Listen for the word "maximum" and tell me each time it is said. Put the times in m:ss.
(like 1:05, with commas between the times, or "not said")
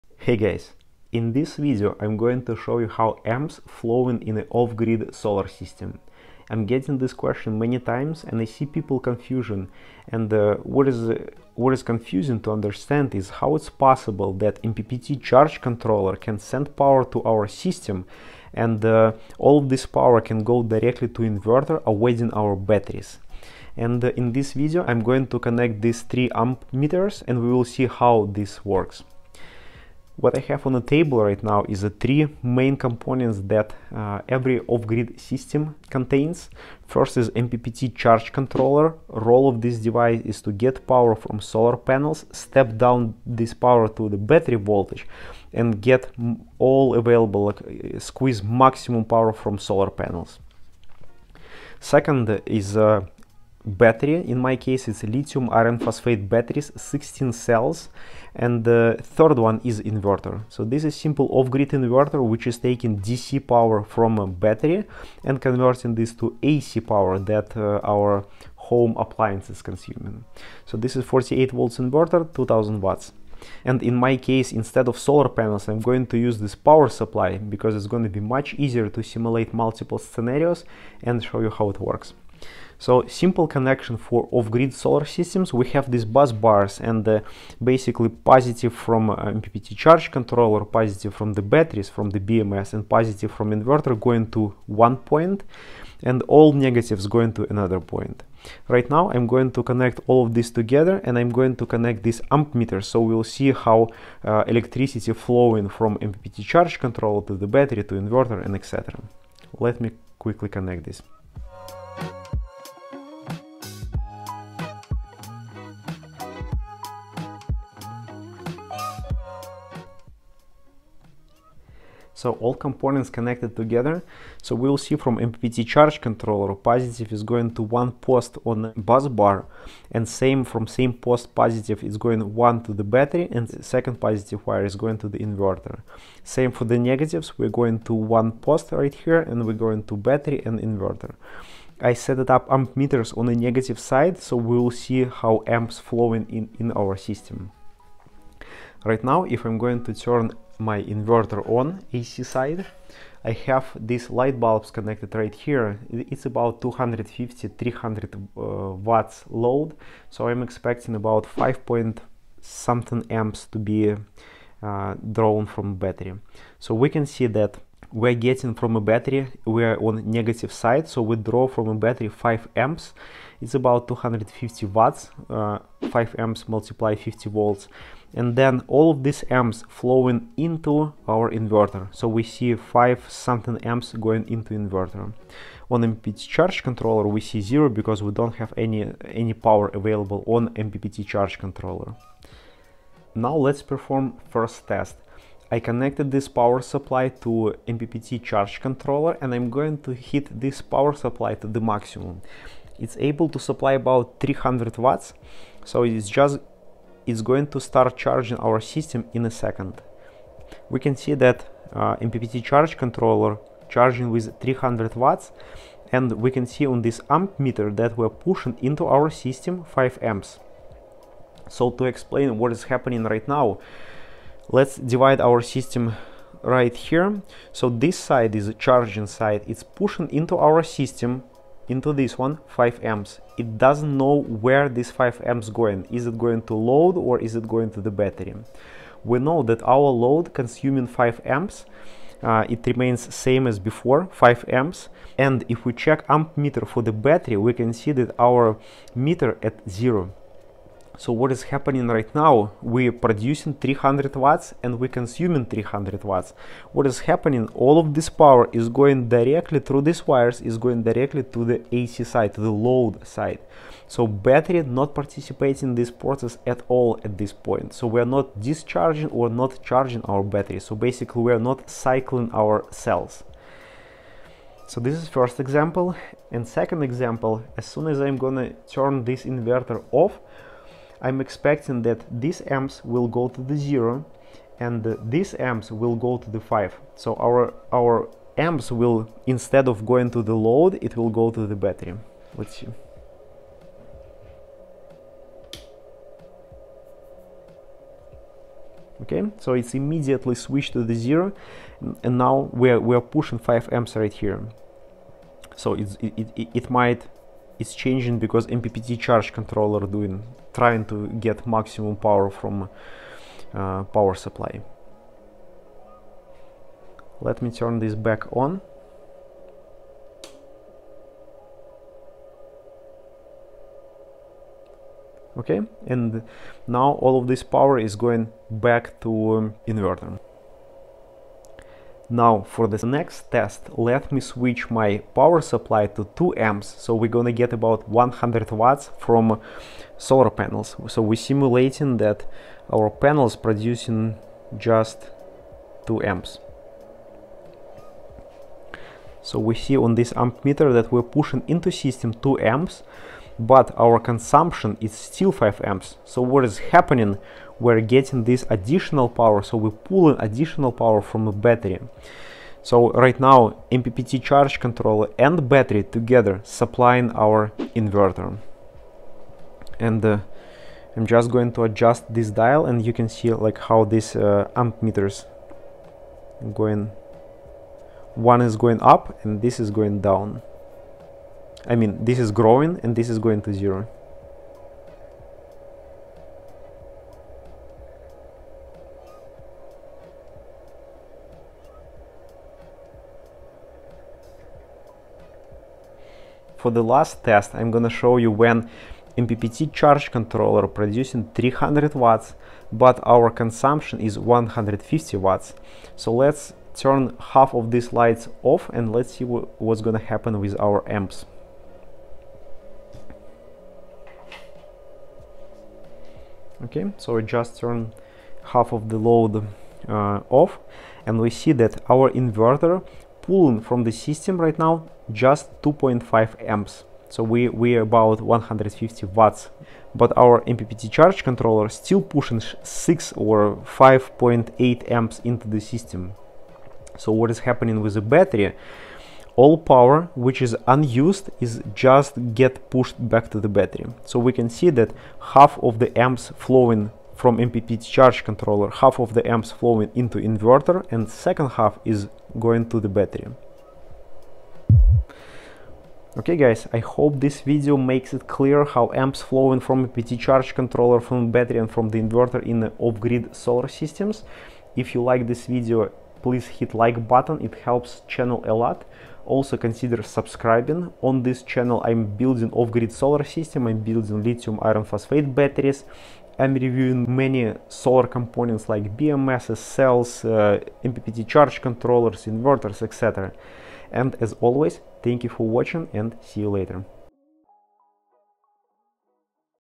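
0:48, 3:21, 5:11.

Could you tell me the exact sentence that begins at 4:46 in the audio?
So our, our amps will, instead of going to the load, it will go to the battery.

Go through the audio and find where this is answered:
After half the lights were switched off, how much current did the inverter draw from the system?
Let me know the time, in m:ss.
7:05.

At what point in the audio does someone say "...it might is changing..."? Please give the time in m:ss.
5:06.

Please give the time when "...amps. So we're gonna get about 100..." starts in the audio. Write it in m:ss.
5:36.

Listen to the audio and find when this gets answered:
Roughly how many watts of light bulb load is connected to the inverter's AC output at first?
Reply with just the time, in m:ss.
2:36.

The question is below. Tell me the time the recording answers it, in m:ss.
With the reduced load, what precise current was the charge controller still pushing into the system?
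7:13.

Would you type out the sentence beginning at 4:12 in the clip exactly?
We're producing 300 watts and we're consuming 300 watts.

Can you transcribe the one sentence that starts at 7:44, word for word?
If you like this video, please hit like button, it helps channel a lot.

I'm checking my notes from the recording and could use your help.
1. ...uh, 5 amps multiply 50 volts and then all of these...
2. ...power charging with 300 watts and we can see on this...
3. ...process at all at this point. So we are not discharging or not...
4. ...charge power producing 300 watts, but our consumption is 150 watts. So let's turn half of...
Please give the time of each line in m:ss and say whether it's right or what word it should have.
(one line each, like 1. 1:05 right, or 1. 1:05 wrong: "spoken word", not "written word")
1. 2:55 right
2. 3:32 wrong: "controller", not "power"
3. 4:25 right
4. 6:39 wrong: "controller", not "power".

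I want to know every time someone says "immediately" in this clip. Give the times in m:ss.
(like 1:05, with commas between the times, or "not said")
4:59.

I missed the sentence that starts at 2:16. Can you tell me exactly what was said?
Same for the negatives, we're going to one post right here and we're going to battery and inverter.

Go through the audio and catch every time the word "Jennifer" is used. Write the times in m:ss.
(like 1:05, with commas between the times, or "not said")
not said.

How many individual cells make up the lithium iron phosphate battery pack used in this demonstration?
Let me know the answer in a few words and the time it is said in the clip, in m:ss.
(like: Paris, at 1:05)
16, at 0:56.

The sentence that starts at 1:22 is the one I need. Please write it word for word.
So simple connection for off-grid solar systems.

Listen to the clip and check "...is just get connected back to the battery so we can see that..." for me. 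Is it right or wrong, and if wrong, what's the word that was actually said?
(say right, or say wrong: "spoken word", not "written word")
wrong: "pushed", not "connected".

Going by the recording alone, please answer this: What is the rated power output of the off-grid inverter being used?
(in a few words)
2000 watts.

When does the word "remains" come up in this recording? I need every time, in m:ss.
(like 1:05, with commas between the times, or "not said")
4:02.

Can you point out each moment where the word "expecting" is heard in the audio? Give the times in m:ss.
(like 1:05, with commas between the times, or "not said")
2:40, 4:41.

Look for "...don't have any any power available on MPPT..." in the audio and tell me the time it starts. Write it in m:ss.
3:08.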